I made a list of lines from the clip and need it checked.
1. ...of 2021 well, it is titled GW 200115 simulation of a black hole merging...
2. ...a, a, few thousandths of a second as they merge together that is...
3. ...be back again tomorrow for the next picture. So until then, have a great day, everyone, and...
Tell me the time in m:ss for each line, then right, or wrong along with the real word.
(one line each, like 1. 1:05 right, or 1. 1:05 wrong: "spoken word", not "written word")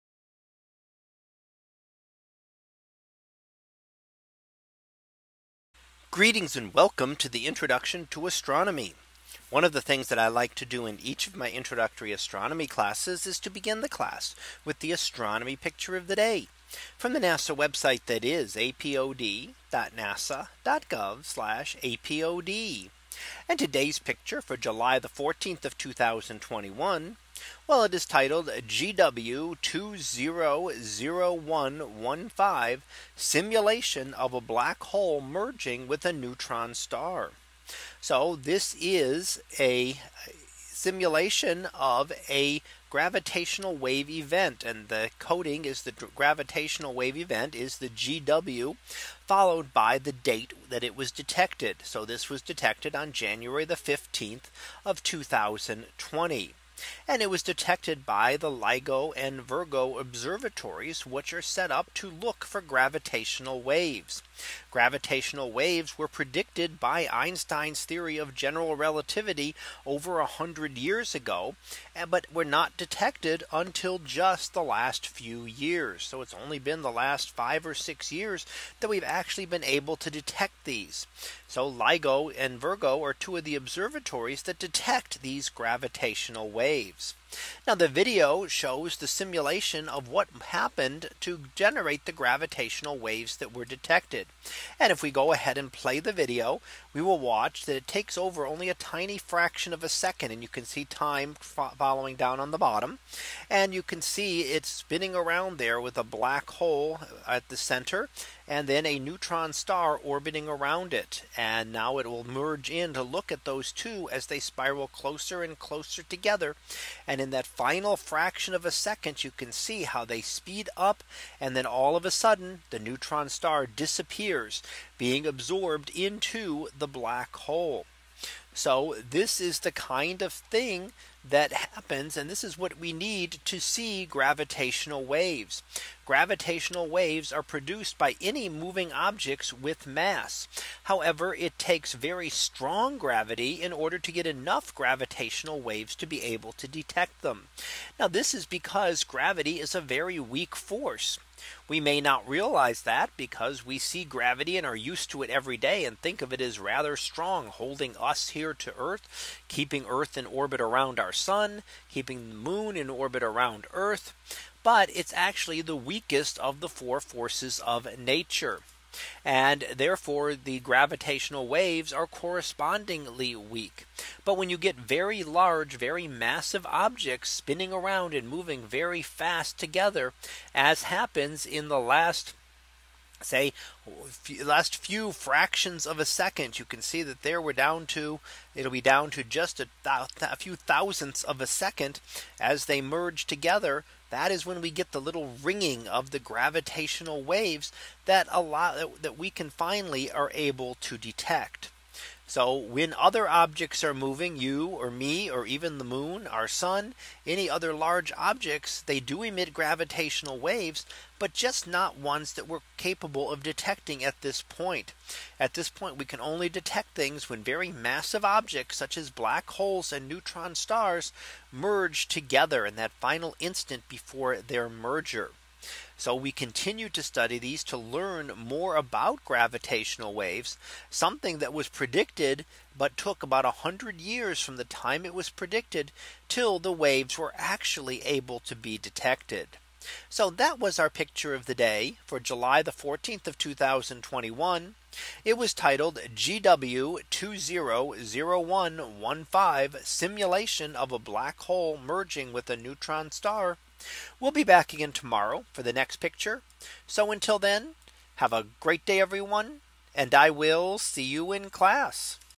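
1. 0:25 right
2. 3:09 right
3. 4:14 right.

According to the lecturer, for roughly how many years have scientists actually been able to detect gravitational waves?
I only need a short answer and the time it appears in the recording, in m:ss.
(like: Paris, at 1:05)
5 or 6 years, at 1:17.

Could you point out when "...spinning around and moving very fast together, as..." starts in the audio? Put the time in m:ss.
2:57.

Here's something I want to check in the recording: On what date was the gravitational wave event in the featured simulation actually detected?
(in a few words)
January 15, 2020.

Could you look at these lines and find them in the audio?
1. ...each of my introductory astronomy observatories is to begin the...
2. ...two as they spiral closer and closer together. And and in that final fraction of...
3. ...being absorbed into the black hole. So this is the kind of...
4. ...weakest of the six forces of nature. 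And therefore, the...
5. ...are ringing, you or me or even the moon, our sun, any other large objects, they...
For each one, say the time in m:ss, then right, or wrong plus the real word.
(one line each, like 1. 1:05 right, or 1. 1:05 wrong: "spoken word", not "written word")
1. 0:11 wrong: "classes", not "observatories"
2. 1:53 right
3. 2:04 right
4. 2:45 wrong: "four", not "six"
5. 3:23 wrong: "moving", not "ringing".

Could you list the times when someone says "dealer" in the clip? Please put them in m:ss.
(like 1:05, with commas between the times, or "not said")
not said.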